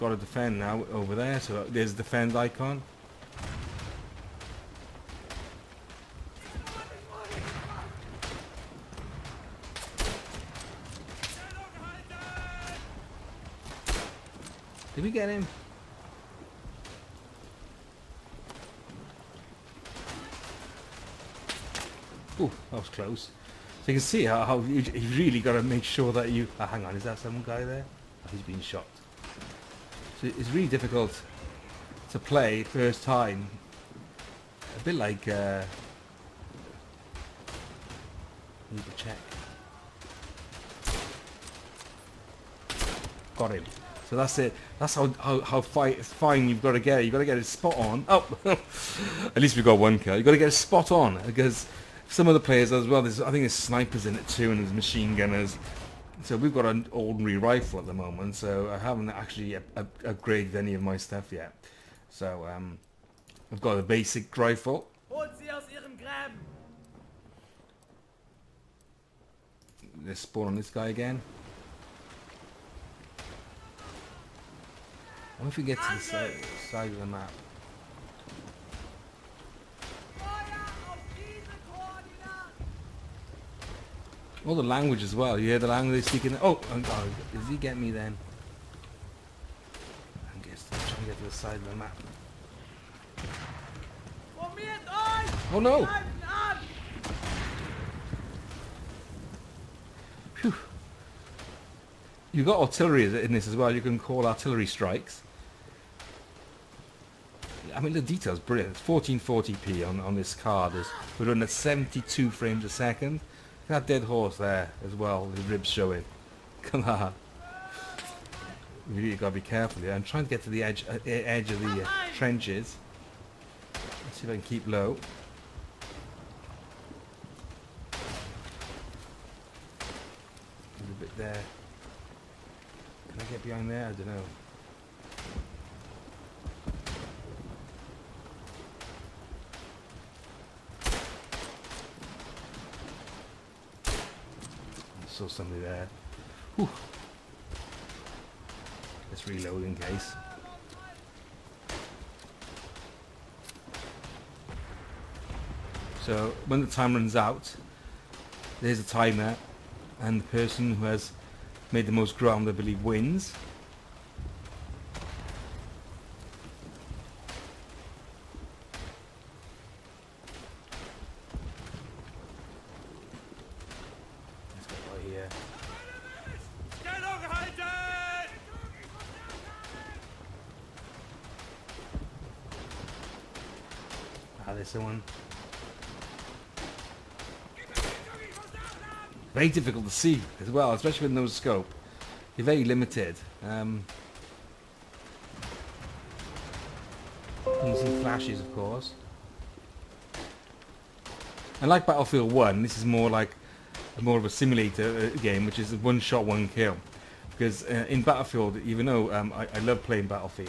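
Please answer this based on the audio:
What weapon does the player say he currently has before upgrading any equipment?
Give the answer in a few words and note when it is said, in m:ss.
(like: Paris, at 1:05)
basic rifle, at 1:03.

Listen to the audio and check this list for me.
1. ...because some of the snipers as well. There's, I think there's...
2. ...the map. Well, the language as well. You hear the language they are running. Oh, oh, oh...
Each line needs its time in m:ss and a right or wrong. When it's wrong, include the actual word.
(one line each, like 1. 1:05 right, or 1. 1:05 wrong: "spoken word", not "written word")
1. 0:51 wrong: "players", not "snipers"
2. 1:17 wrong: "speaking", not "running".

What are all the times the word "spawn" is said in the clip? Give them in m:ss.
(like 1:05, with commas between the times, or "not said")
1:10.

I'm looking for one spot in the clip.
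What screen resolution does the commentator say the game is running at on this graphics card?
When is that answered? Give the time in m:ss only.
1:48.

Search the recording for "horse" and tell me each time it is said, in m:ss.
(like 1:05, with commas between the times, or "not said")
1:54.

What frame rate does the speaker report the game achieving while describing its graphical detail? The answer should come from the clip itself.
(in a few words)
72 frames a second.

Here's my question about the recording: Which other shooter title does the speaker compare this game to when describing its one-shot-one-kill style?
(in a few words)
Battlefield 1.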